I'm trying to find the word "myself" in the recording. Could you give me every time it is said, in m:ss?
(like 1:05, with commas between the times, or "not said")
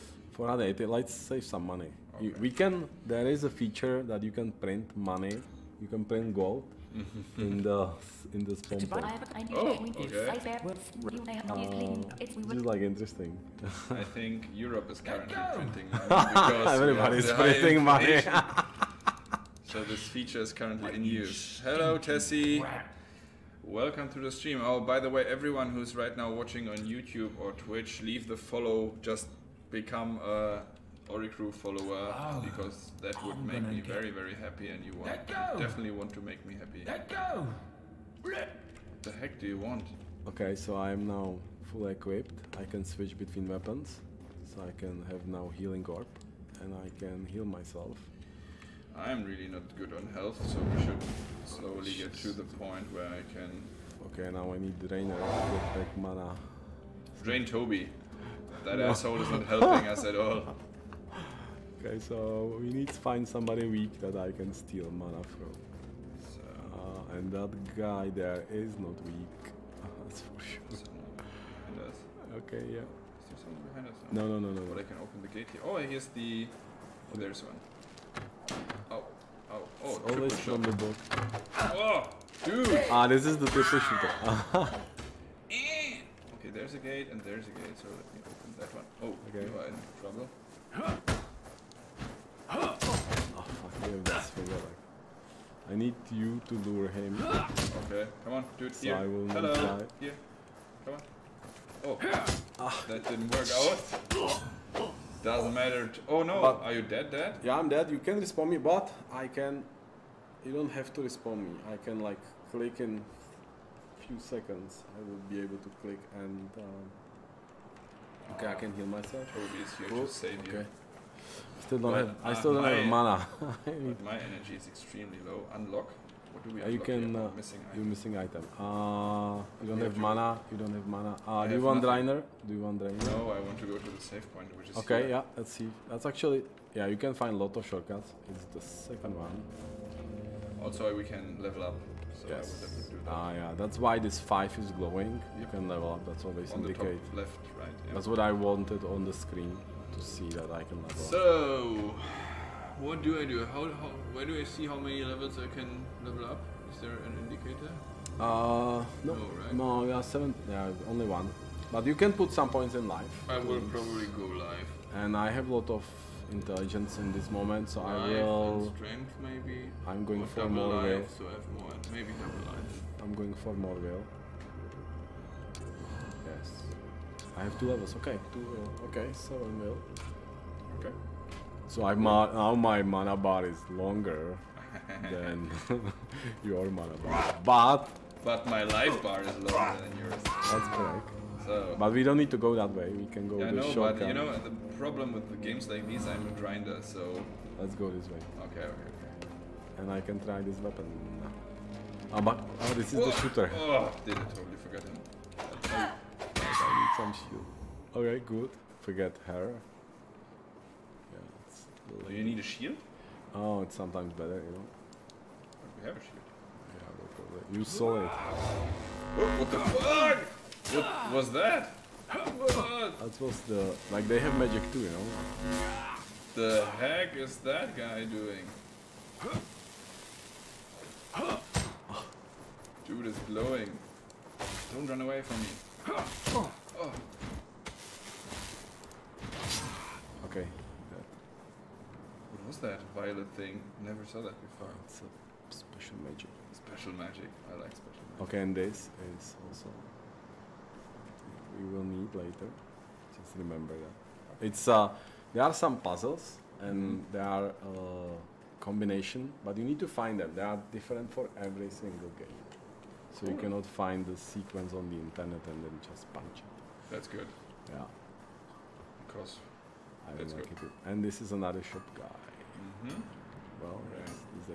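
0:47, 1:58.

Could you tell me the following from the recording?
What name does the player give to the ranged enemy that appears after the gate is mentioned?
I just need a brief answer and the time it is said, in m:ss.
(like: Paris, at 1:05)
the triple shooter, at 1:23.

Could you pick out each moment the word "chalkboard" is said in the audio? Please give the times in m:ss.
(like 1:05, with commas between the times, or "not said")
not said.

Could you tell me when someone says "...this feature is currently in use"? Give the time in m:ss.
0:19.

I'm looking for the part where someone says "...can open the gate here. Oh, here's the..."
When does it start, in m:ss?
1:14.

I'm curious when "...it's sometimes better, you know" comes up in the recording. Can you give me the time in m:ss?
3:33.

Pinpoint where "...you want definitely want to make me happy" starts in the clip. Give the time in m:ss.
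0:34.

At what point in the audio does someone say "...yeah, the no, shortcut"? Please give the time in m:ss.
3:13.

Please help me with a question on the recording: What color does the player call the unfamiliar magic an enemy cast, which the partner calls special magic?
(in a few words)
violet.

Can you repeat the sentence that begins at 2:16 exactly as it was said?
Yeah, you can find a lot of shortcuts.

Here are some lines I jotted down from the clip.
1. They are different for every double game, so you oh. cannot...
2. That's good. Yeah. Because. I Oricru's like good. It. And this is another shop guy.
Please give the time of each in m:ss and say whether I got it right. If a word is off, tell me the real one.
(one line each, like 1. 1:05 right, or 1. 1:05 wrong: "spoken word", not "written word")
1. 4:20 wrong: "single", not "double"
2. 4:26 wrong: "That", not "Oricru".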